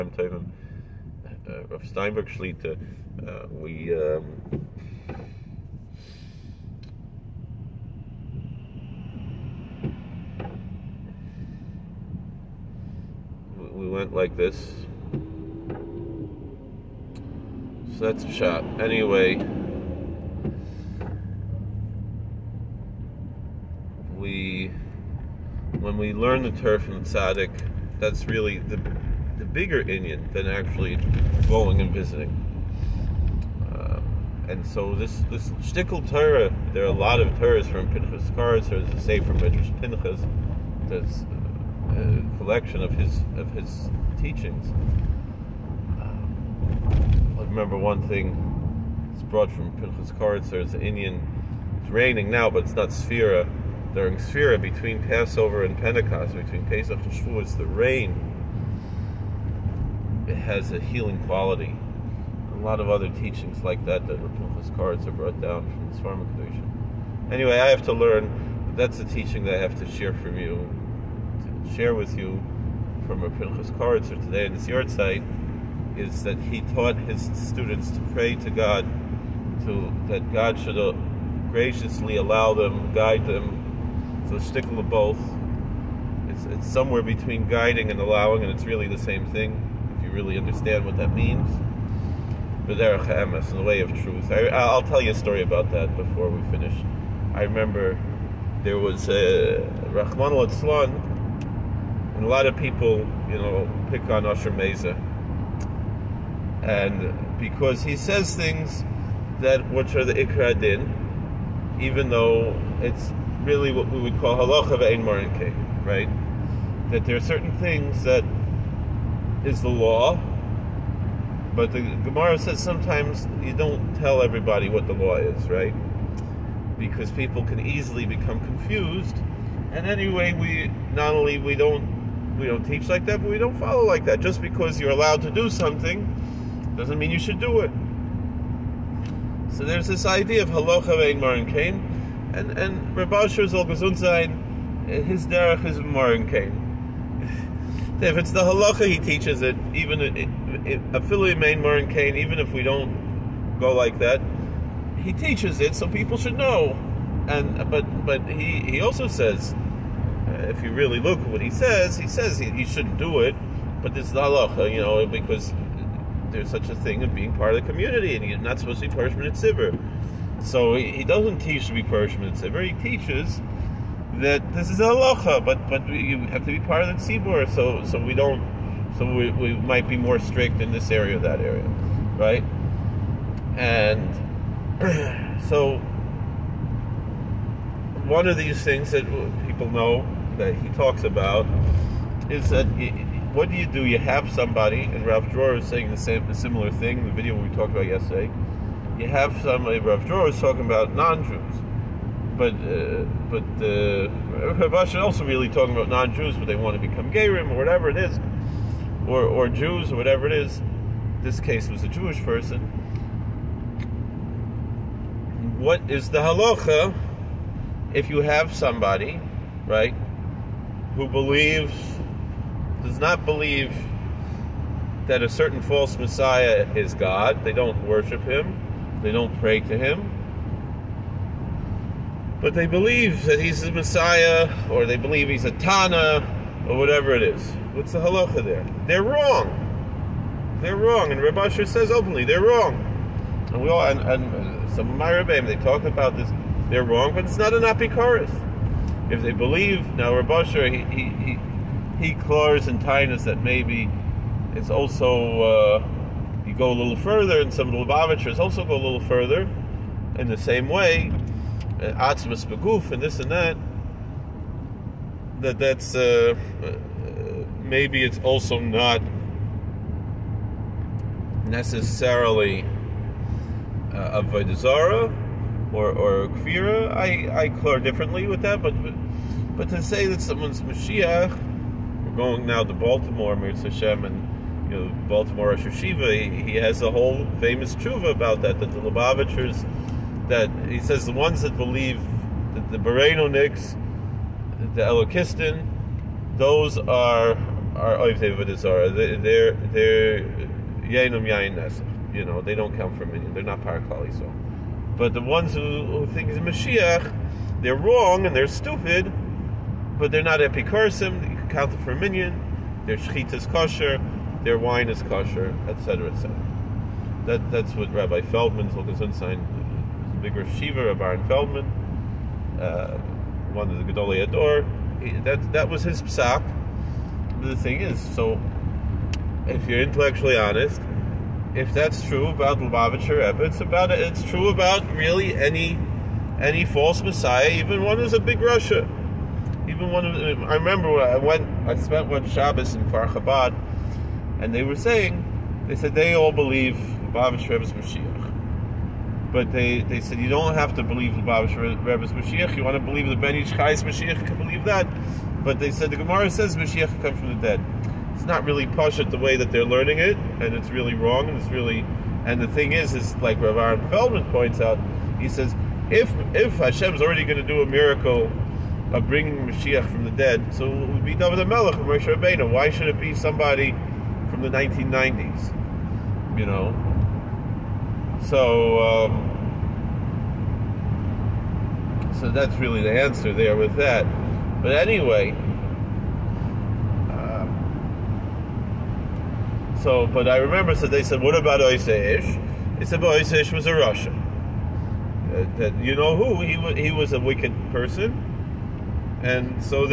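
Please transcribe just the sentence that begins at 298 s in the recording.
Oh, they're they're Yainum Yain You know, they don't count for a they They're not Parakali.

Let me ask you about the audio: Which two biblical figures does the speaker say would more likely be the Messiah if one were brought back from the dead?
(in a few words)
David Melech or Moshe Rabbeinu.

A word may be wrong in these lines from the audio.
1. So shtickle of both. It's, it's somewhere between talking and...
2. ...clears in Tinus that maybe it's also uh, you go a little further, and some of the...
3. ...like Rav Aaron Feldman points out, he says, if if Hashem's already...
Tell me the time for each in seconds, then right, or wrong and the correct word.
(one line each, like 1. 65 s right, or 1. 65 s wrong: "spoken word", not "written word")
1. 84 s wrong: "guiding", not "talking"
2. 252 s right
3. 363 s right.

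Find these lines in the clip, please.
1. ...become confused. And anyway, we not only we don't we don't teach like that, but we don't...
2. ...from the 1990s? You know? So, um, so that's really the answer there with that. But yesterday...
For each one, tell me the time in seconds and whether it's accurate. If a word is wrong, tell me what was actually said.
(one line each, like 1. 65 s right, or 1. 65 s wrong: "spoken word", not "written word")
1. 128 s right
2. 374 s wrong: "anyway", not "yesterday".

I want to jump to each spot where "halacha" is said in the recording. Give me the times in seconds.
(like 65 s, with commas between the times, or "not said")
114 s, 140 s, 148 s, 164 s, 174 s, 216 s, 237 s.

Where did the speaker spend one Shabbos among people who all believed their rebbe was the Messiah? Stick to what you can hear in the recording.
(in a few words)
Kfar Chabad.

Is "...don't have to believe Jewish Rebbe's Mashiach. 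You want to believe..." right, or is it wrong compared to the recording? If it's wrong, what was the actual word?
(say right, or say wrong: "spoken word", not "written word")
wrong: "Lubavitch", not "Jewish".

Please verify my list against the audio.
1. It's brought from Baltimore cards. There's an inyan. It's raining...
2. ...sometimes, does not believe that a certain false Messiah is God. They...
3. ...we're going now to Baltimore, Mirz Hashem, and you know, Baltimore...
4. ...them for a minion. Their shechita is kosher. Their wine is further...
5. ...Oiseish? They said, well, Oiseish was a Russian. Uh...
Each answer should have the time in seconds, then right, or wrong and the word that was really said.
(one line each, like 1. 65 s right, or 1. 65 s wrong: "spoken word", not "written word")
1. 49 s wrong: "Pinchas", not "Baltimore"
2. 221 s wrong: "believes", not "sometimes"
3. 282 s right
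4. 311 s wrong: "kosher", not "further"
5. 391 s right.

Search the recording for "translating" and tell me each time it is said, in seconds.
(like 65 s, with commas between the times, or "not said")
not said.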